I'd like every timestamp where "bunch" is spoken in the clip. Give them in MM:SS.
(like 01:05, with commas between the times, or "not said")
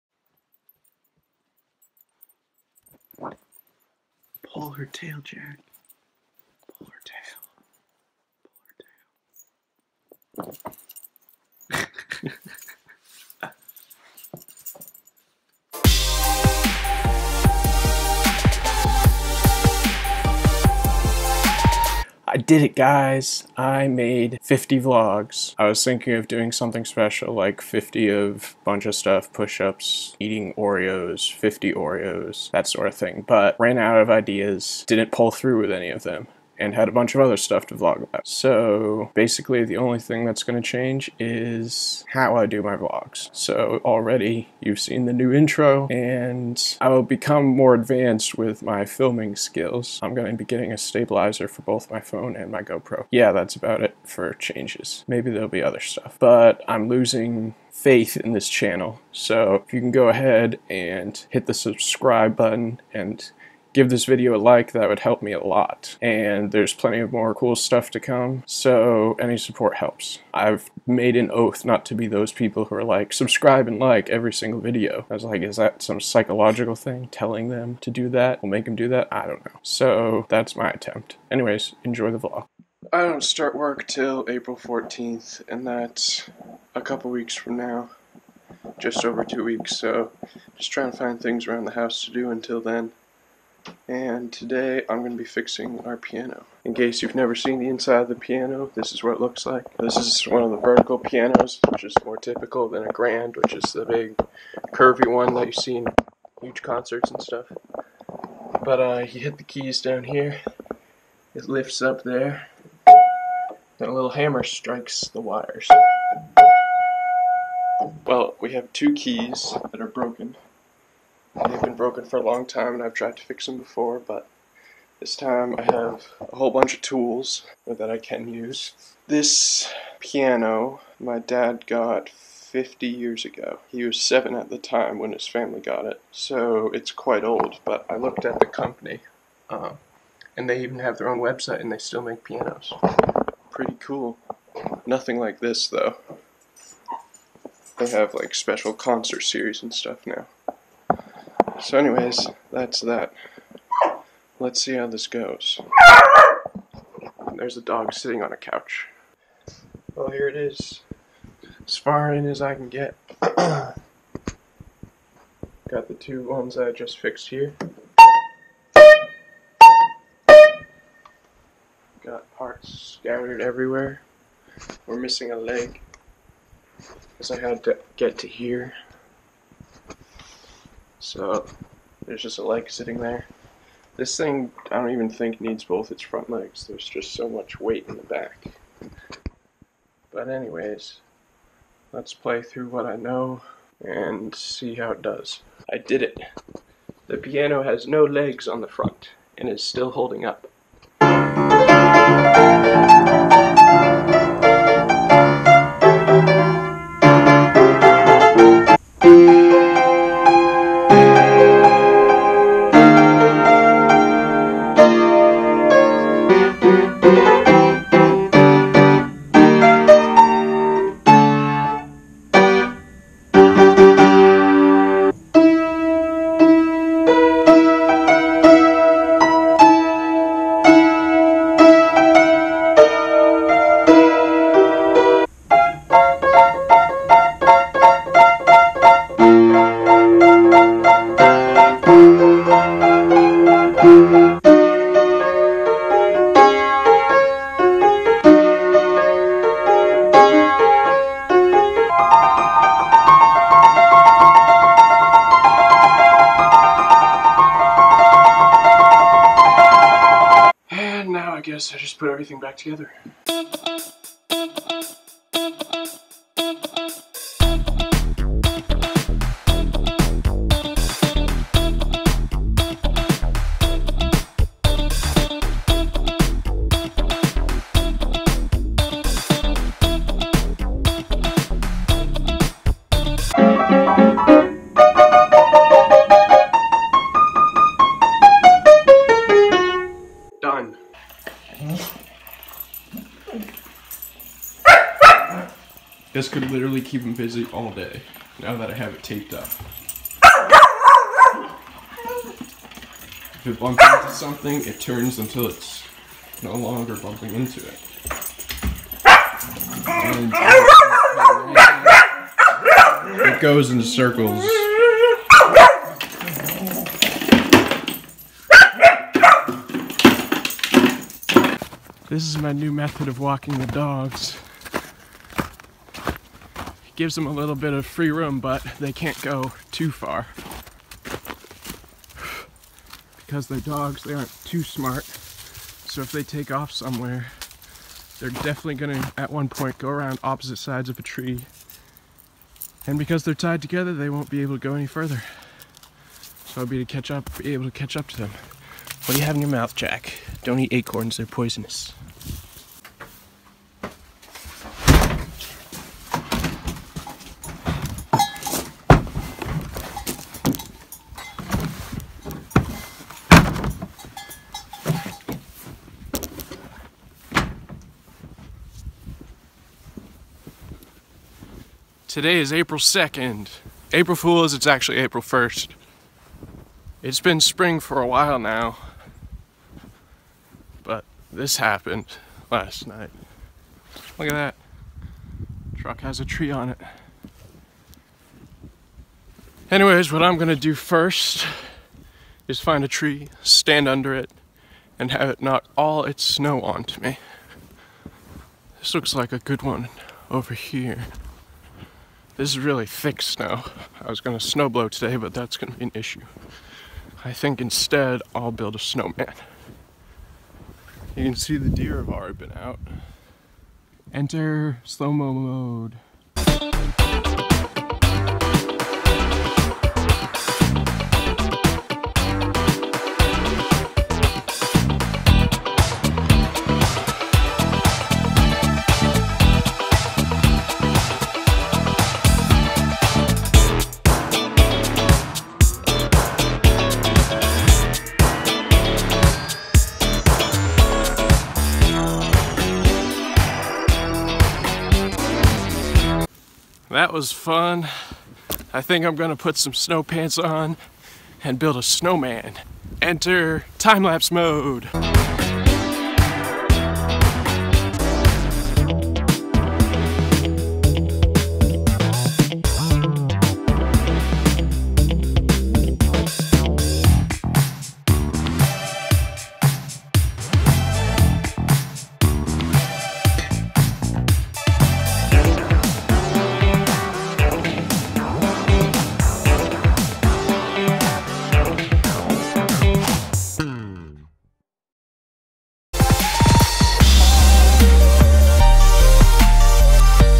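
00:28, 00:36, 02:06.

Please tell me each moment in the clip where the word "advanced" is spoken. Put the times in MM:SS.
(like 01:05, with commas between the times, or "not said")
00:47.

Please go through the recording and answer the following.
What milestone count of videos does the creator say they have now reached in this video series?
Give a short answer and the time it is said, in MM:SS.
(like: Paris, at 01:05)
50, at 00:24.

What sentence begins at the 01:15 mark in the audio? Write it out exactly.
I was like, is that some psychological thing telling them to do that?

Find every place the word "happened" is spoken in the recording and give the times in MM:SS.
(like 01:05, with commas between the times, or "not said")
06:21.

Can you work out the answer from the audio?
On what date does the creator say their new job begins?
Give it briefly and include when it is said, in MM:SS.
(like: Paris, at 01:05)
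April 14th, at 01:24.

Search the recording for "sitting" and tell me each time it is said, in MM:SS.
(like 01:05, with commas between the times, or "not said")
02:37, 03:02.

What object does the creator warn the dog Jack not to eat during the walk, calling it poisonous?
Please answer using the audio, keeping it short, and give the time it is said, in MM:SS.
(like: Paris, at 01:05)
acorns, at 05:50.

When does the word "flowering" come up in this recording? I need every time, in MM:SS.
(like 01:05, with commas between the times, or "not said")
not said.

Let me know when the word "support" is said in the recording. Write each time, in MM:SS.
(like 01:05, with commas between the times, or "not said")
01:09.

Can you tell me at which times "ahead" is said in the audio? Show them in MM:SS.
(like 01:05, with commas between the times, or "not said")
01:00.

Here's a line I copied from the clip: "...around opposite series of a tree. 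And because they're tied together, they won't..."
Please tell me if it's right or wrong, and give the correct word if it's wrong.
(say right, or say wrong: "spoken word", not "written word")
wrong: "sides", not "series".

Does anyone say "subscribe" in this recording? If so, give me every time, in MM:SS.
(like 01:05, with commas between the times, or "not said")
01:01, 01:13.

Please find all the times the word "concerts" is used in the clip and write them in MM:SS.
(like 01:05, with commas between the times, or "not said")
01:46, 02:28.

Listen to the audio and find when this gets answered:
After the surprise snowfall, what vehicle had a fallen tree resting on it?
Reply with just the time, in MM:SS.
06:25.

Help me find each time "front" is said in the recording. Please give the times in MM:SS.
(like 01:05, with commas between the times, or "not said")
03:06, 03:18.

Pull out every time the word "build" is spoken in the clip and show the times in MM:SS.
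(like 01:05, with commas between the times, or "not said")
06:48, 07:31.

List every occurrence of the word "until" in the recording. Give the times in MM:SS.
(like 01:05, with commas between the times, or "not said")
01:32, 05:05.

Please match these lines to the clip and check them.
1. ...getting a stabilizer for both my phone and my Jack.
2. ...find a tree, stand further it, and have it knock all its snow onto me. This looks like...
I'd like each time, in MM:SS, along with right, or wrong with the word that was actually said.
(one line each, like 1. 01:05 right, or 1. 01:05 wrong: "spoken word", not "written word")
1. 00:50 wrong: "GoPro", not "Jack"
2. 06:32 wrong: "under", not "further".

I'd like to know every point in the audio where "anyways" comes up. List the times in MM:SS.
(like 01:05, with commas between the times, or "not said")
01:21, 02:31, 03:10, 06:29.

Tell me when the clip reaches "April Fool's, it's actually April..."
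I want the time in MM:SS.
06:13.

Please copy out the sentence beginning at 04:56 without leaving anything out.
This could literally keep him busy all day, now that I have it taped up.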